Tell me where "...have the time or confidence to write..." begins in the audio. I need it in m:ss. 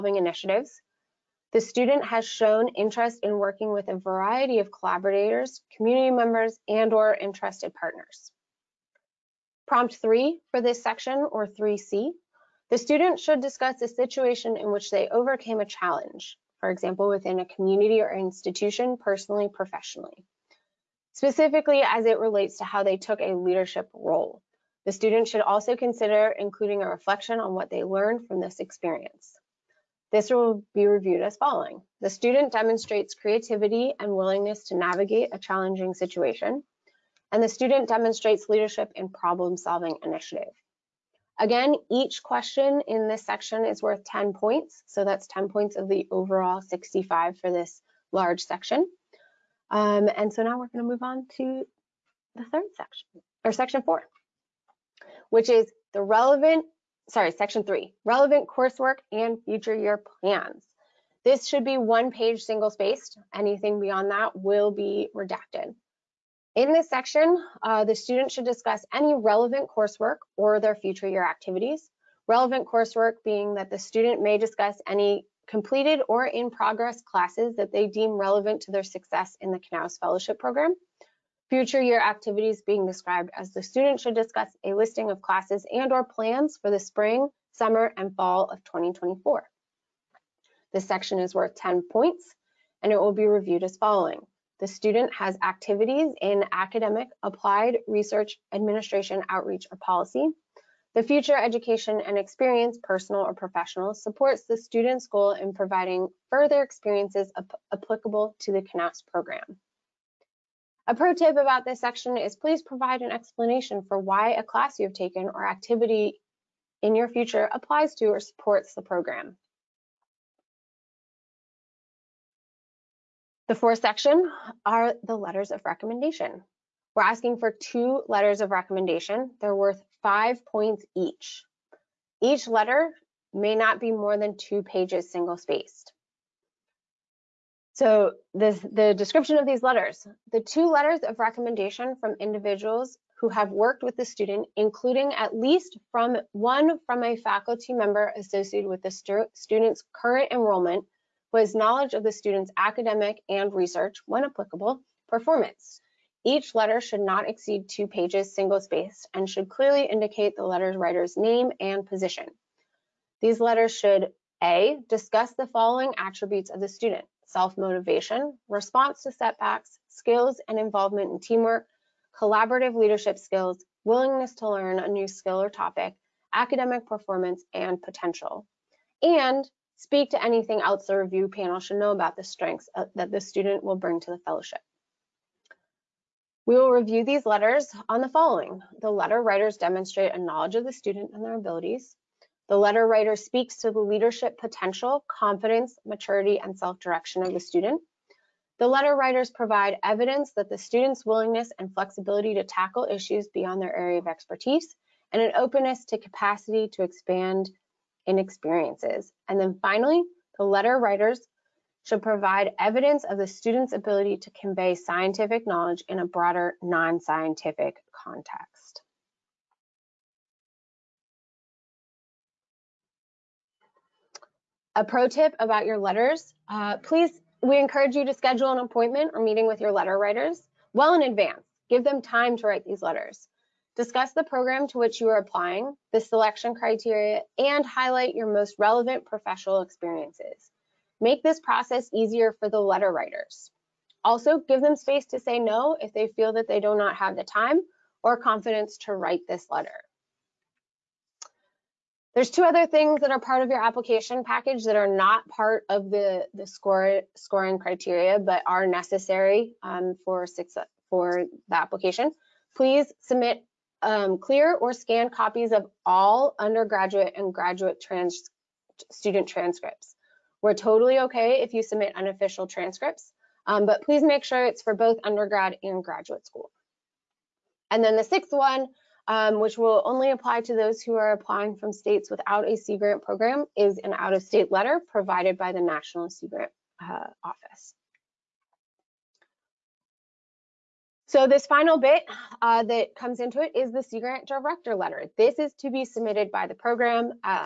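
4:06.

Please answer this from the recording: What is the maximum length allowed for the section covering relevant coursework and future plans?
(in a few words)
One page single spaced.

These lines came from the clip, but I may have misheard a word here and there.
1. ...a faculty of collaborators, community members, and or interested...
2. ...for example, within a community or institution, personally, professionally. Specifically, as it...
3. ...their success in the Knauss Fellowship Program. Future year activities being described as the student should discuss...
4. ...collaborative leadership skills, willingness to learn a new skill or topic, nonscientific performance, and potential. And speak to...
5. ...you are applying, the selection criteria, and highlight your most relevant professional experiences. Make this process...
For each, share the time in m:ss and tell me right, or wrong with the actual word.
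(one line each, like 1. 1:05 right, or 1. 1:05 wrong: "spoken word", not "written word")
1. 0:03 wrong: "variety", not "faculty"
2. 0:16 right
3. 1:18 right
4. 2:52 wrong: "academic", not "nonscientific"
5. 3:54 right.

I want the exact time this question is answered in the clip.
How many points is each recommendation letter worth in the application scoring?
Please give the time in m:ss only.
2:10.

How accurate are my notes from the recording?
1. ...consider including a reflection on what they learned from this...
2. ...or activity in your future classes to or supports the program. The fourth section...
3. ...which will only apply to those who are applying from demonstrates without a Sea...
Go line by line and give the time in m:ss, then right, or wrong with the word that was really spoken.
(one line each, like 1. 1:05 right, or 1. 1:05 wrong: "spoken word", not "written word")
1. 0:25 right
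2. 1:55 wrong: "applies", not "classes"
3. 4:39 wrong: "states", not "demonstrates".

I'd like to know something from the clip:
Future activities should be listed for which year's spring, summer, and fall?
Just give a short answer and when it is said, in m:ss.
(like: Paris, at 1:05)
2024, at 1:28.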